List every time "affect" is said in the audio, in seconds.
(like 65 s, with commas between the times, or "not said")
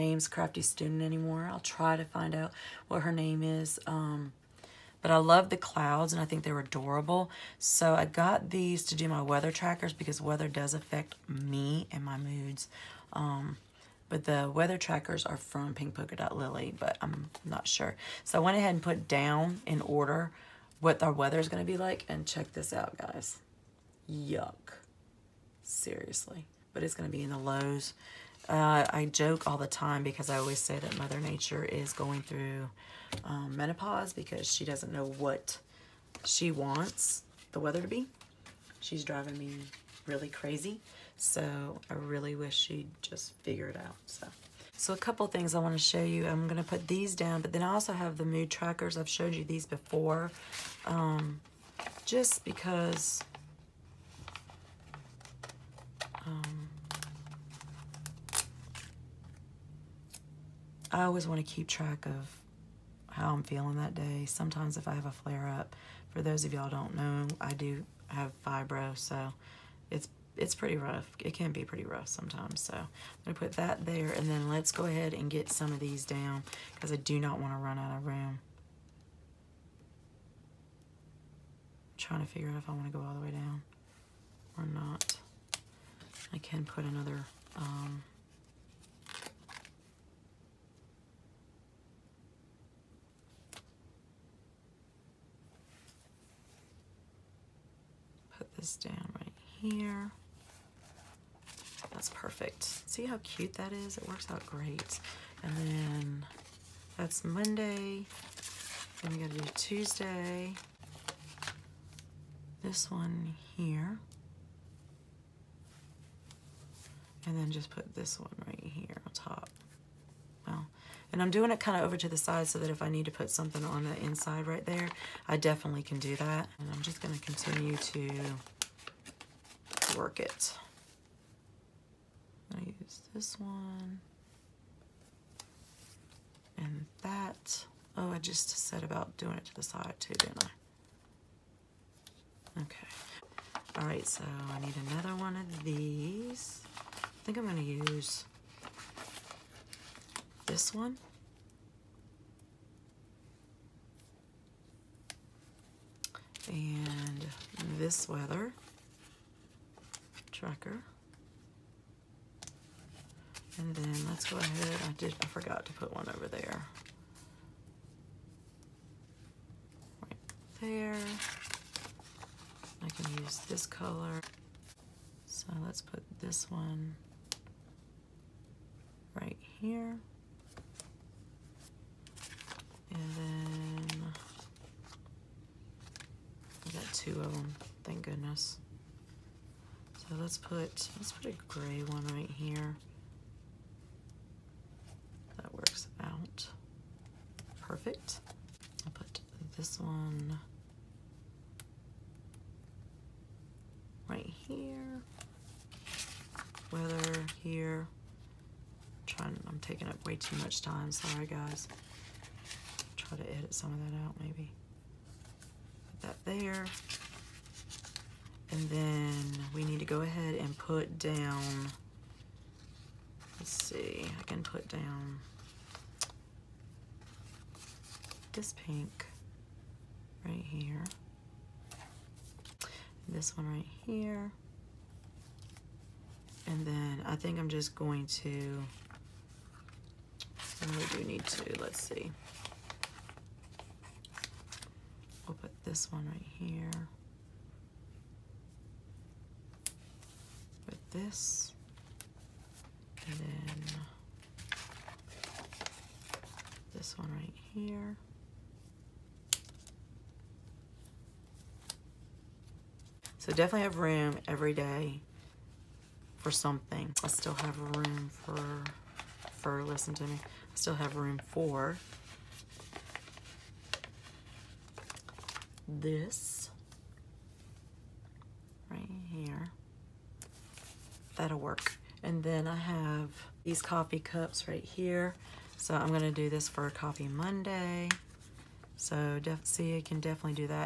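10 s.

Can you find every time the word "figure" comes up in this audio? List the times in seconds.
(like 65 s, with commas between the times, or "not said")
43 s, 82 s.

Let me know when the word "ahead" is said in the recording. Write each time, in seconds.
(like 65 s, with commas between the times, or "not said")
18 s, 74 s, 164 s, 220 s.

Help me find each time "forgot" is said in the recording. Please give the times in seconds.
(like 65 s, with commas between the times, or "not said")
165 s.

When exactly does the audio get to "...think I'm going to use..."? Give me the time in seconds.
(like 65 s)
147 s.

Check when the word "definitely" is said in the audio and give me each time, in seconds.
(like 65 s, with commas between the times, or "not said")
125 s, 263 s, 289 s.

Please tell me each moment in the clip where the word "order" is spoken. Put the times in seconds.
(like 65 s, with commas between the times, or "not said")
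19 s.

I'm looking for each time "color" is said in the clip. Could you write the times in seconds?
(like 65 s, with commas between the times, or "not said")
173 s.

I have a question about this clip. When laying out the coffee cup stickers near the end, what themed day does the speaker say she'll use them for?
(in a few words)
Coffee Monday.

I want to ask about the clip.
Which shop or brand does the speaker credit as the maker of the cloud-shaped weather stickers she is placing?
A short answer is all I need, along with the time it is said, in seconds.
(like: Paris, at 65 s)
Pink Polka Dot Lily, at 15 s.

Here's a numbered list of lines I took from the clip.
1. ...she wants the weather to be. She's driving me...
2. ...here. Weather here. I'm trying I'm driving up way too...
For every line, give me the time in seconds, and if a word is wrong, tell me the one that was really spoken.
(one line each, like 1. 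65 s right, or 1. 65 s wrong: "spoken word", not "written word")
1. 36 s right
2. 204 s wrong: "taking", not "driving".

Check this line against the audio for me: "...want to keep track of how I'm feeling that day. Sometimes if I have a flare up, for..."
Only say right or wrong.
right.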